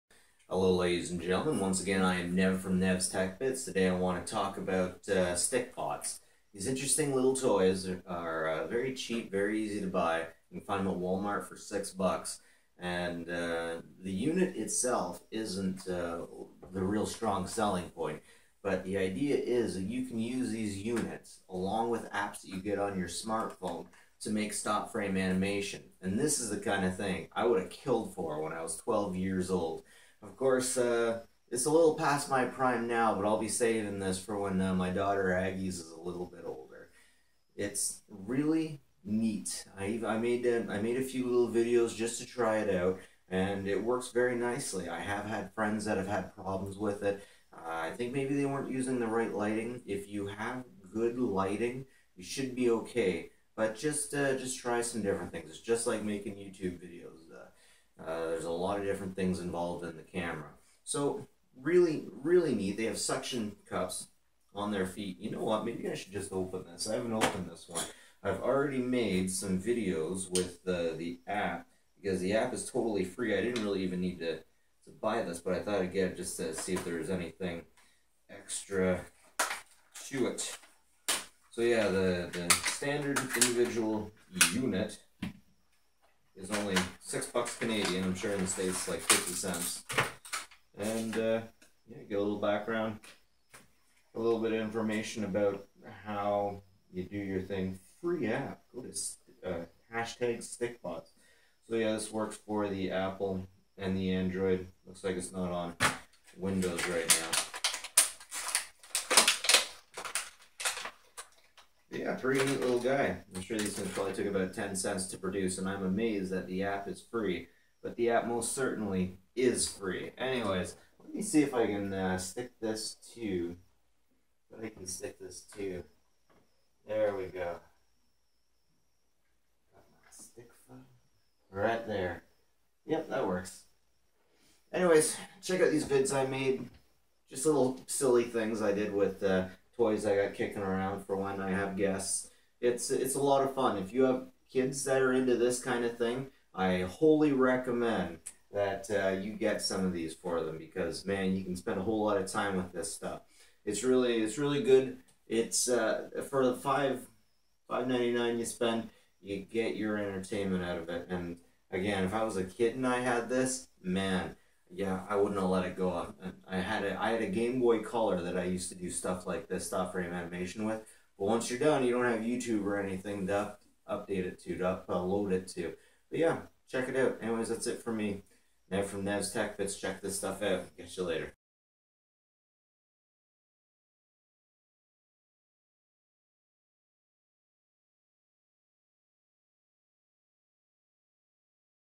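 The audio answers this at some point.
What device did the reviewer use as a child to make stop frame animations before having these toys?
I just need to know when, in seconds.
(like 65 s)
167 s.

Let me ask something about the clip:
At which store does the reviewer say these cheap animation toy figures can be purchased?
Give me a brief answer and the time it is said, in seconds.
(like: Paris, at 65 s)
Walmart, at 10 s.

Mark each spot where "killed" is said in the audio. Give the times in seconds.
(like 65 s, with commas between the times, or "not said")
27 s.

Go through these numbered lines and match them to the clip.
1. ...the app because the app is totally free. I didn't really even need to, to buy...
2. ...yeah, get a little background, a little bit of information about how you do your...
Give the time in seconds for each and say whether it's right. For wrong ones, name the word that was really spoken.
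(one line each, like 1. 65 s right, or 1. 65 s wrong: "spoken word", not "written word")
1. 70 s right
2. 91 s right.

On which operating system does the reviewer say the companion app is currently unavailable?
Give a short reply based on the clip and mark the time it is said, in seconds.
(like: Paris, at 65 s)
Windows, at 106 s.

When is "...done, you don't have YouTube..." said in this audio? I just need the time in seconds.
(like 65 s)
171 s.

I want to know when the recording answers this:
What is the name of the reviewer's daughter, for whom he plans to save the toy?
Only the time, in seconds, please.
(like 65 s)
35 s.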